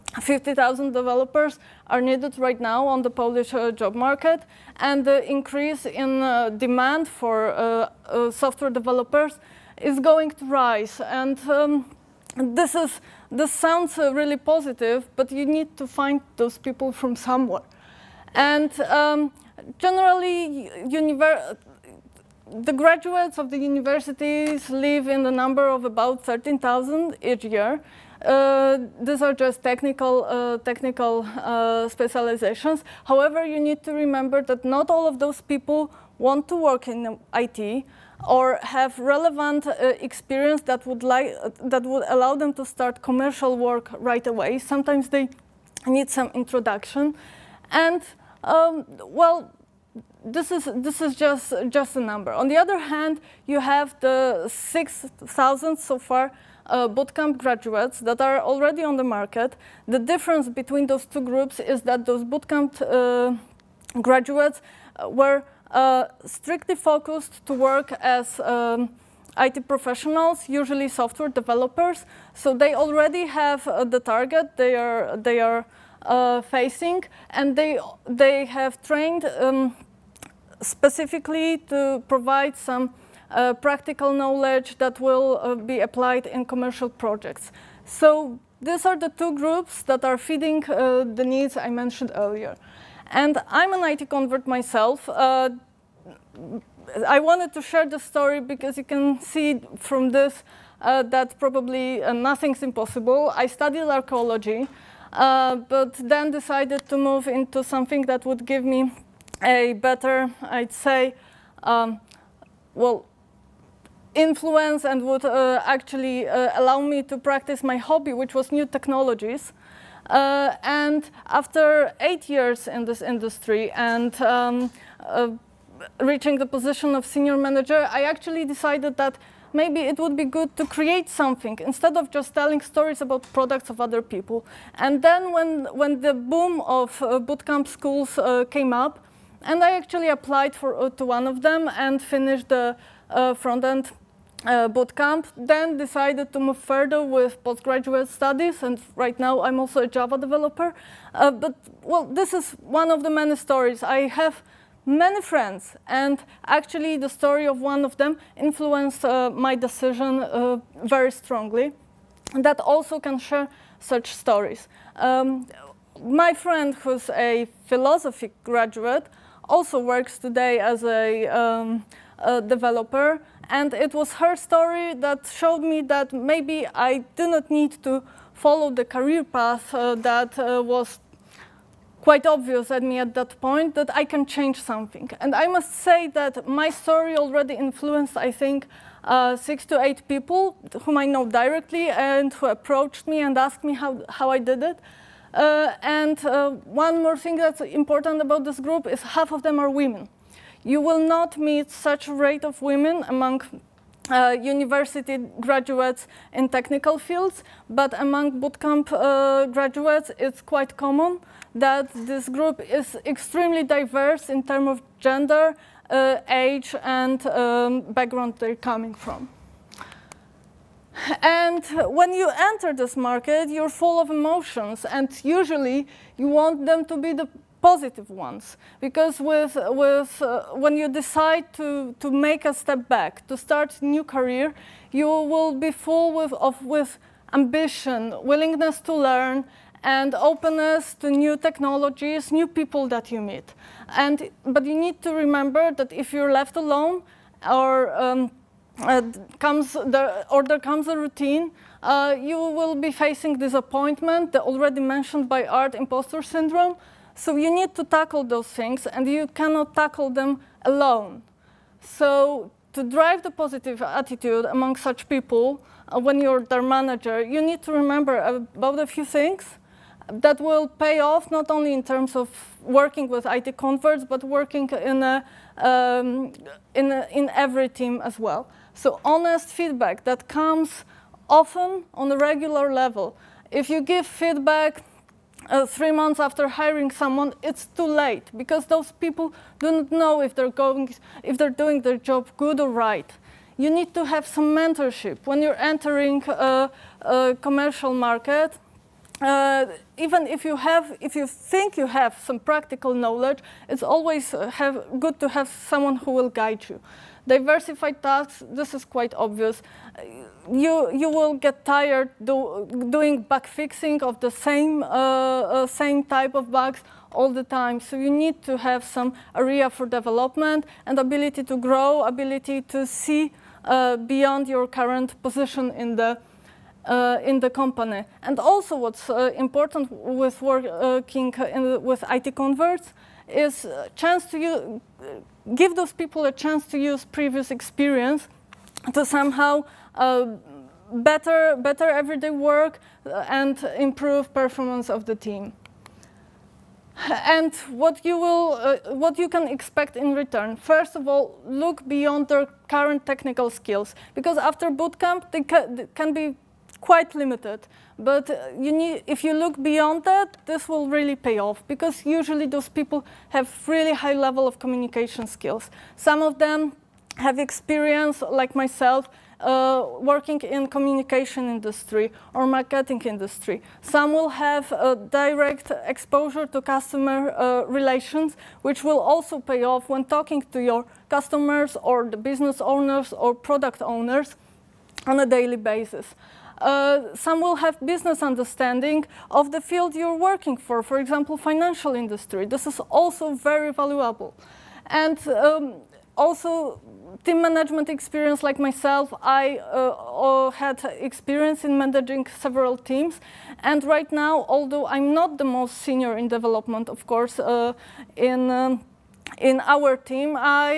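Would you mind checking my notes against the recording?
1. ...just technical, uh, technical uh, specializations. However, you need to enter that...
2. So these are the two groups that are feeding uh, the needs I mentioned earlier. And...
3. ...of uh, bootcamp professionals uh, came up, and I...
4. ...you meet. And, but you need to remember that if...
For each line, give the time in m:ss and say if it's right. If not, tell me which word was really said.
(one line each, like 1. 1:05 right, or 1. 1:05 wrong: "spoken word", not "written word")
1. 0:29 wrong: "remember", not "enter"
2. 1:27 right
3. 2:16 wrong: "schools", not "professionals"
4. 4:03 right.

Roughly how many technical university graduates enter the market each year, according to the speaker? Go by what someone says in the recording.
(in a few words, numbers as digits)
13,000.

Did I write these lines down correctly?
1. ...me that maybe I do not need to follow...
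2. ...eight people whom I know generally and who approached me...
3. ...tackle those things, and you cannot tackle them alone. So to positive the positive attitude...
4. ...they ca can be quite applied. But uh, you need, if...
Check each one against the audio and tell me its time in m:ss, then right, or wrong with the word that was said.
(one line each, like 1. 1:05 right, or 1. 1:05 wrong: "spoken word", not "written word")
1. 2:55 right
2. 3:09 wrong: "directly", not "generally"
3. 4:17 wrong: "drive", not "positive"
4. 5:55 wrong: "limited", not "applied".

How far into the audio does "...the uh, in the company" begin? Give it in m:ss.
5:25.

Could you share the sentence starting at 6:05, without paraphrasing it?
Some of them have experience, like myself, uh, working in communication industry or marketing industry.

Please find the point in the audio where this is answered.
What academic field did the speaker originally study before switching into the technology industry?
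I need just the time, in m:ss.
1:43.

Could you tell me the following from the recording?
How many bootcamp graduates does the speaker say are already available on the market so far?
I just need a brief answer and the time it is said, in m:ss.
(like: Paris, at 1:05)
6,000, at 0:54.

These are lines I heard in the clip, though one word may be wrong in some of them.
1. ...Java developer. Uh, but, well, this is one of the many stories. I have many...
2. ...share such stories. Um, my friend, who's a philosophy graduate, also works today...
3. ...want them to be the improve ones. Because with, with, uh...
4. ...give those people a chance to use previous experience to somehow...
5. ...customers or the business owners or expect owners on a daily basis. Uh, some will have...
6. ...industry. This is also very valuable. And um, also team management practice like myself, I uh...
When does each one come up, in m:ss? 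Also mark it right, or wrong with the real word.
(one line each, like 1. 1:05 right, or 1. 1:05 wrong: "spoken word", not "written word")
1. 2:29 right
2. 2:43 right
3. 3:46 wrong: "positive", not "improve"
4. 5:35 right
5. 6:21 wrong: "product", not "expect"
6. 6:31 wrong: "experience", not "practice".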